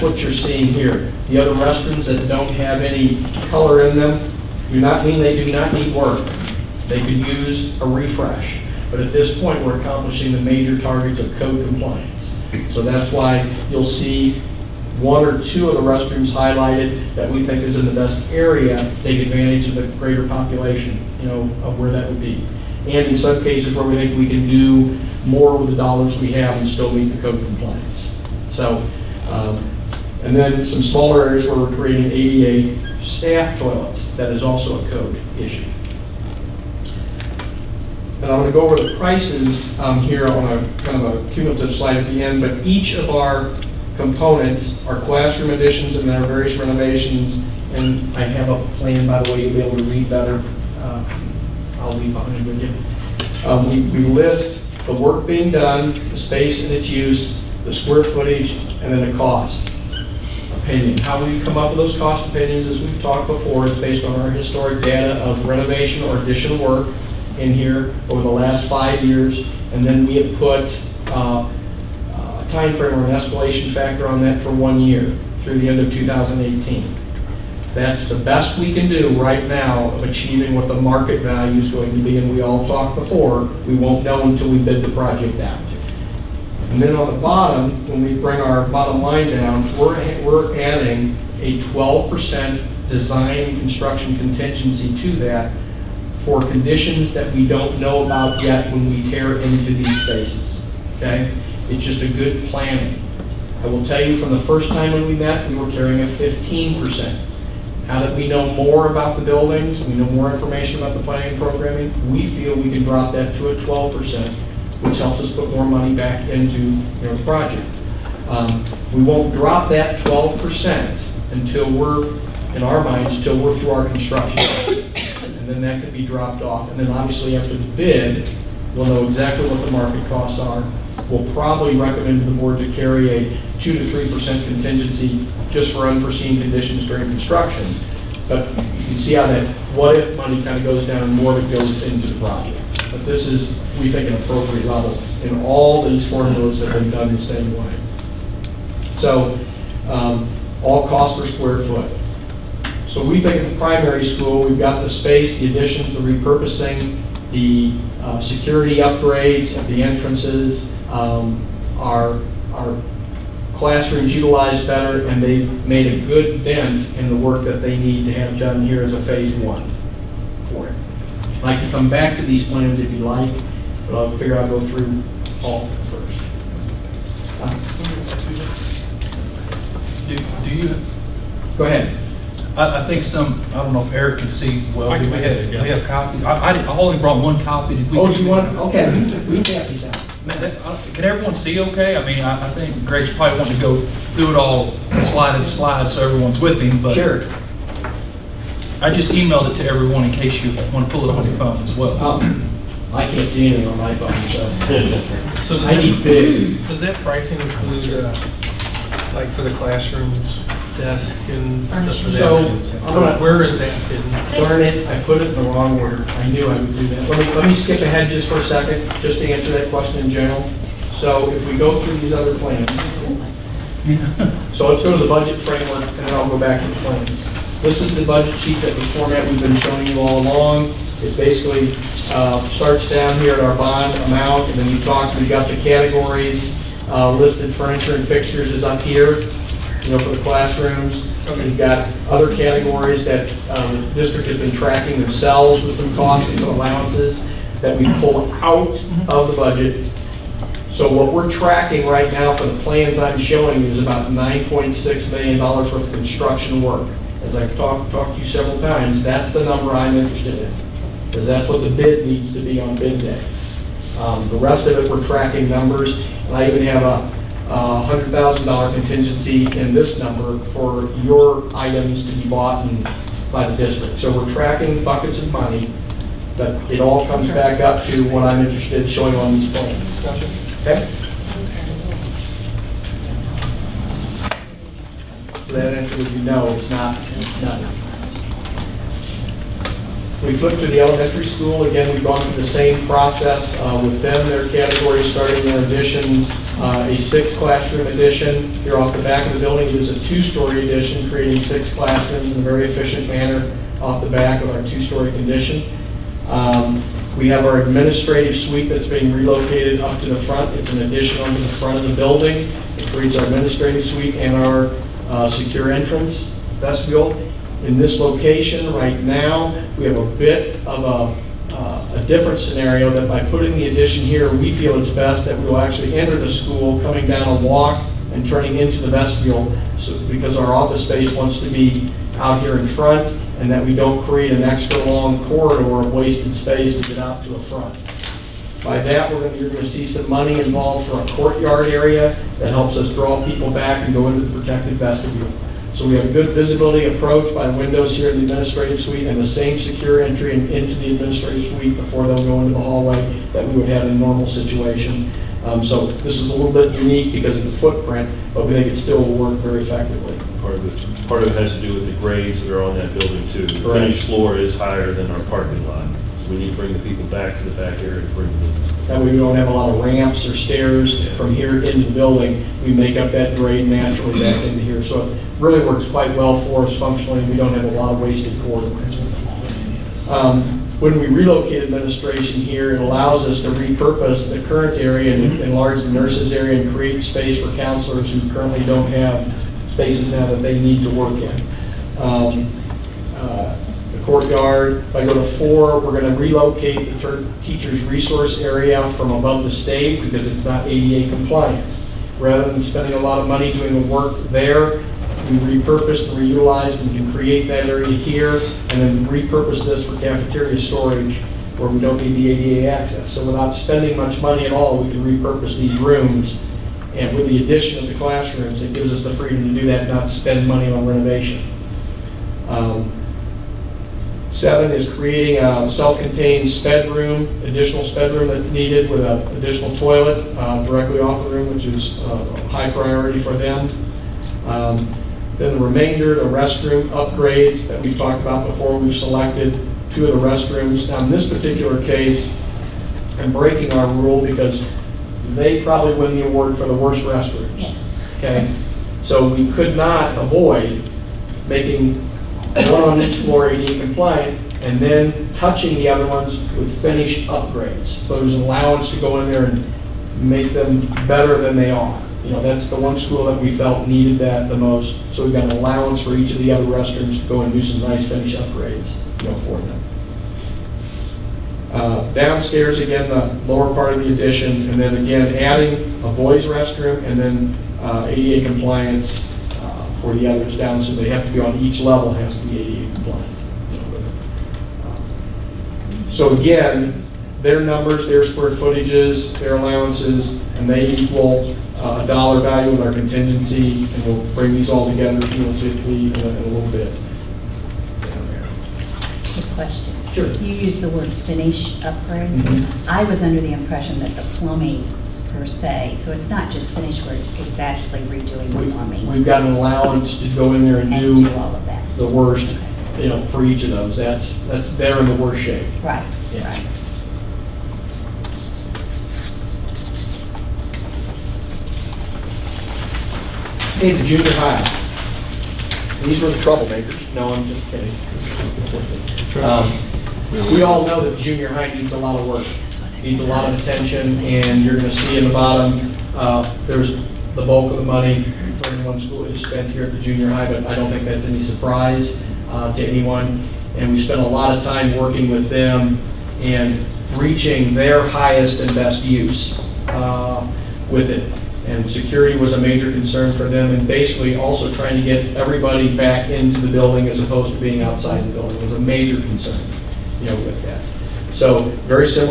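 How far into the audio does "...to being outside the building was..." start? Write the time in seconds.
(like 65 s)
557 s.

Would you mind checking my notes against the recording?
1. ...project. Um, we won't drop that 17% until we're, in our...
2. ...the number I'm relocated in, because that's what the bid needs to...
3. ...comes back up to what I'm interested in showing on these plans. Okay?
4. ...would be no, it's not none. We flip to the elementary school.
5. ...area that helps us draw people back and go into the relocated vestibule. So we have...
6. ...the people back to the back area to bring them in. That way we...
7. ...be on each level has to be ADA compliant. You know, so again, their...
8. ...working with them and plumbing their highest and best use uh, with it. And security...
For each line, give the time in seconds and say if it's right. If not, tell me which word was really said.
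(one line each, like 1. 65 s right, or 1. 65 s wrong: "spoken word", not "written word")
1. 117 s wrong: "12", not "17"
2. 259 s wrong: "interested", not "relocated"
3. 277 s right
4. 285 s right
5. 341 s wrong: "protected", not "relocated"
6. 366 s right
7. 481 s right
8. 544 s wrong: "reaching", not "plumbing".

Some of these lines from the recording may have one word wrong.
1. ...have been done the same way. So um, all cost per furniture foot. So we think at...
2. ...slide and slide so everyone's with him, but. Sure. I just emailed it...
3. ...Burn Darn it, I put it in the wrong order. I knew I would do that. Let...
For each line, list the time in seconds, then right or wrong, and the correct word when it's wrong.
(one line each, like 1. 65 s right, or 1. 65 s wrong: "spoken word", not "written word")
1. 146 s wrong: "square", not "furniture"
2. 195 s right
3. 214 s right.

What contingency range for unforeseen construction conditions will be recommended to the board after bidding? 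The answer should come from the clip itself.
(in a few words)
2 to 3%.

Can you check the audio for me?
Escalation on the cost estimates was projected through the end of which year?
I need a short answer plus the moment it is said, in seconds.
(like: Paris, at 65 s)
2018, at 75 s.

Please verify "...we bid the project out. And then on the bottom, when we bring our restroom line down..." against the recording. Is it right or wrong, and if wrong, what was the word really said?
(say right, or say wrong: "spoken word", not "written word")
wrong: "bottom", not "restroom".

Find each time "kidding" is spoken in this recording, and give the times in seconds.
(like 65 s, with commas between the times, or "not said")
527 s.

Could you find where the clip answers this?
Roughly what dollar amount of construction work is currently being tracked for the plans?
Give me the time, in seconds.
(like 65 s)
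254 s.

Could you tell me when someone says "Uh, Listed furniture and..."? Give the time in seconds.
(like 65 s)
236 s.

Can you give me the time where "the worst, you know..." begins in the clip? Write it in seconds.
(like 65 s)
511 s.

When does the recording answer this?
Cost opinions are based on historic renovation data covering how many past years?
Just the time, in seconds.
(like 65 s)
68 s.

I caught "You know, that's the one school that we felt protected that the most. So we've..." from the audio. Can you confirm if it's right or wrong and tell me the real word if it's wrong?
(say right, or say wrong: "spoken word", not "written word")
wrong: "needed", not "protected".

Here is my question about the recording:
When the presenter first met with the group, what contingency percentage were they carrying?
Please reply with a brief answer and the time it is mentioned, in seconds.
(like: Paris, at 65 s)
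15%, at 106 s.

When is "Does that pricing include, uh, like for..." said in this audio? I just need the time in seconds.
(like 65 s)
206 s.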